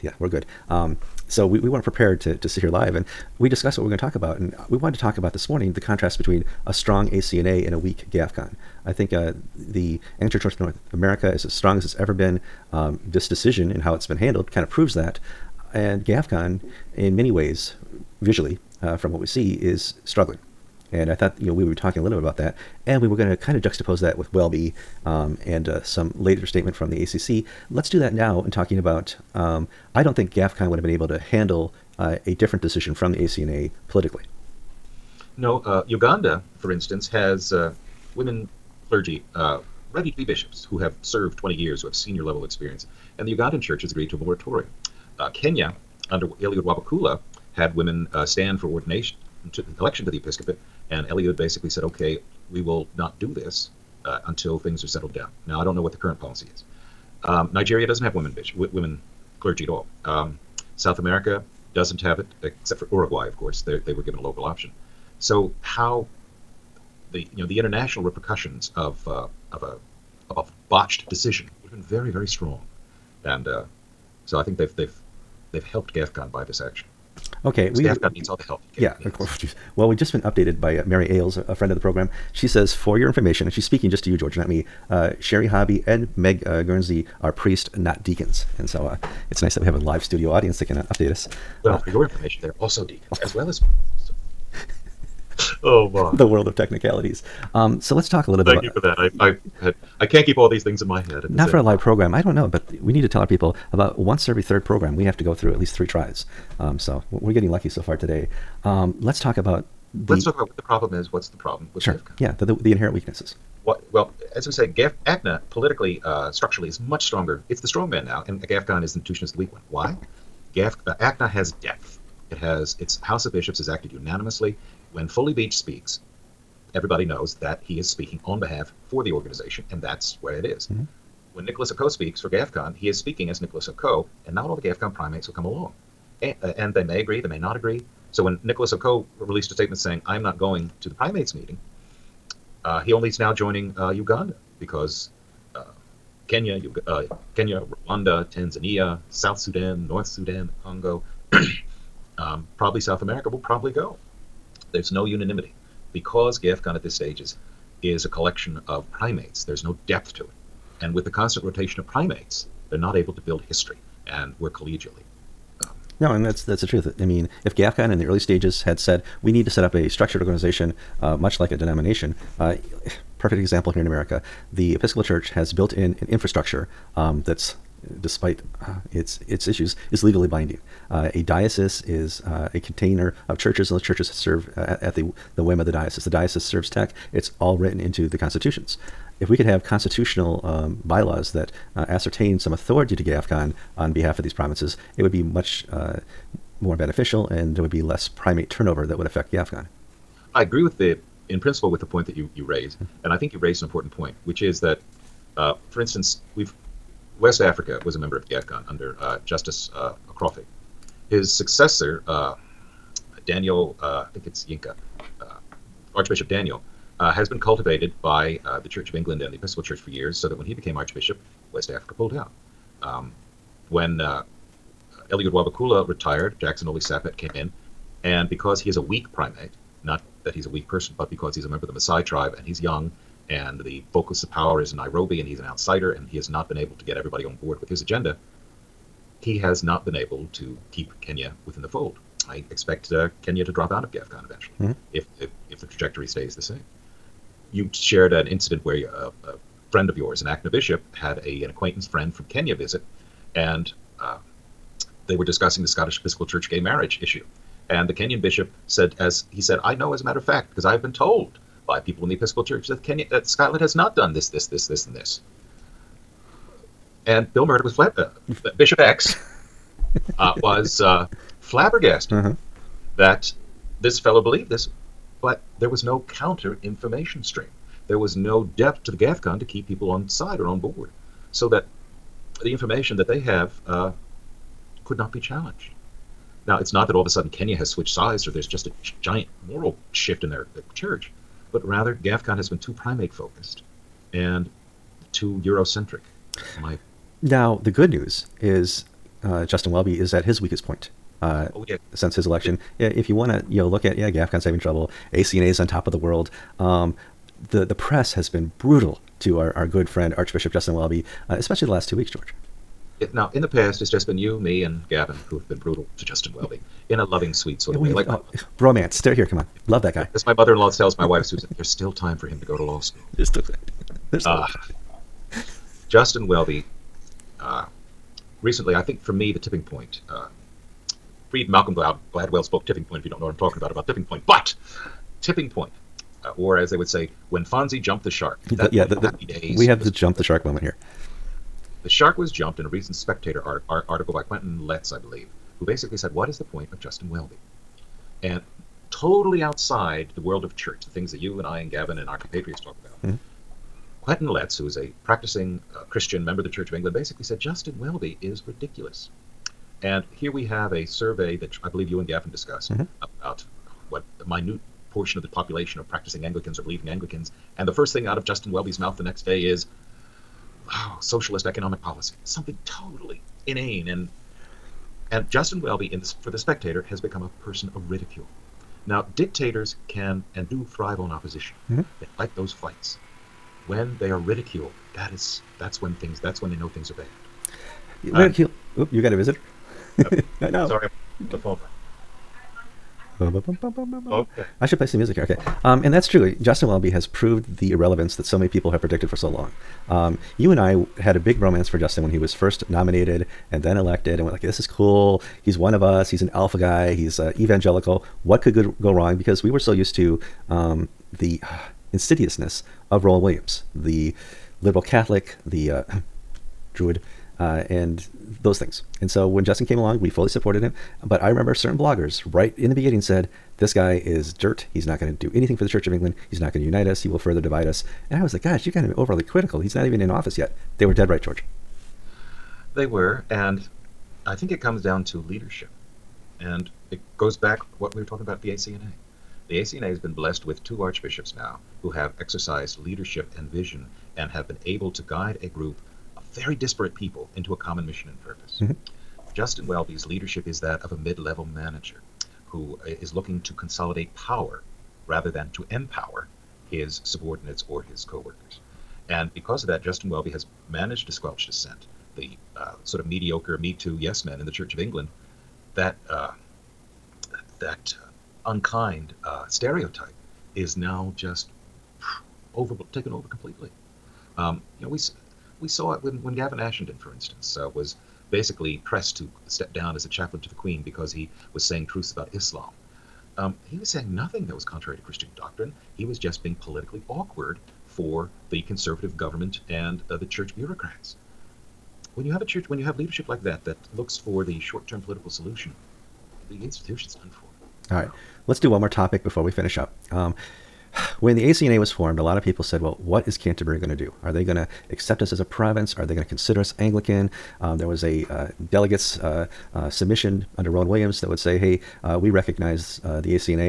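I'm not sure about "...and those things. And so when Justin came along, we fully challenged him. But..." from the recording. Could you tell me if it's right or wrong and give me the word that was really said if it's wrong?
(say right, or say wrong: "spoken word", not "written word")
wrong: "supported", not "challenged".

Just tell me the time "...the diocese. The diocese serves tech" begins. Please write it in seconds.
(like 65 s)
185 s.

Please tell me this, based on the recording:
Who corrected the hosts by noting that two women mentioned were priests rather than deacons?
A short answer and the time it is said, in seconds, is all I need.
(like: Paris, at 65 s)
Mary Ailes, at 80 s.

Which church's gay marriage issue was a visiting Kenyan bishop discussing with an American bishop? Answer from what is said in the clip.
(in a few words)
Scottish Episcopal Church.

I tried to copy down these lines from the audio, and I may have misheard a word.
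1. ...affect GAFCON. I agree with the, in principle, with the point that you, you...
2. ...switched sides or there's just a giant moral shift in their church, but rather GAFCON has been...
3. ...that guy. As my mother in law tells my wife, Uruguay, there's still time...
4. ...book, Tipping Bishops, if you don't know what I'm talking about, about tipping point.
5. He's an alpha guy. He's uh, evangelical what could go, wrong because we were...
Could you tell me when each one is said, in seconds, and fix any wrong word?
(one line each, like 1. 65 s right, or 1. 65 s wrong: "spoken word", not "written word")
1. 199 s right
2. 287 s right
3. 319 s wrong: "Susan", not "Uruguay"
4. 332 s wrong: "Point", not "Bishops"
5. 406 s right.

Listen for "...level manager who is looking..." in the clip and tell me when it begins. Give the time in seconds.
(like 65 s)
451 s.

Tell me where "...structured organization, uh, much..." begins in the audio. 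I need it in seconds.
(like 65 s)
169 s.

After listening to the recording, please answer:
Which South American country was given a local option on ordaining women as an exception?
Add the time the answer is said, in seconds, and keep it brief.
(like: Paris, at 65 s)
Uruguay, at 62 s.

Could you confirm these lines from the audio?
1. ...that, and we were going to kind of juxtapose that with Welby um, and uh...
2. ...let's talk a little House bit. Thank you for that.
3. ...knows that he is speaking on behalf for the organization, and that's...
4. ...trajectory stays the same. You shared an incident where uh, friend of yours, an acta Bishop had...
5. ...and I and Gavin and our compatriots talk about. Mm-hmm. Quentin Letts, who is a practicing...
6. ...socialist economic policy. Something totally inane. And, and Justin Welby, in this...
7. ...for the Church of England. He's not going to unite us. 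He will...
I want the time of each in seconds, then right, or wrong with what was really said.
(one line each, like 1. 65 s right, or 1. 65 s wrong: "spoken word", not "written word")
1. 22 s right
2. 97 s wrong: "Thank", not "House"
3. 127 s right
4. 245 s right
5. 351 s right
6. 371 s right
7. 425 s right.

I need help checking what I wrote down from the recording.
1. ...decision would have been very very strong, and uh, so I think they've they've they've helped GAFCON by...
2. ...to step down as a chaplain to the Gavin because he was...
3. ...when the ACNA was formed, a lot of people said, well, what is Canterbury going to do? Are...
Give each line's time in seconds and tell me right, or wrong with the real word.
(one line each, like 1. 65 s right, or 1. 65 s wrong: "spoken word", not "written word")
1. 71 s right
2. 479 s wrong: "Queen", not "Gavin"
3. 501 s right.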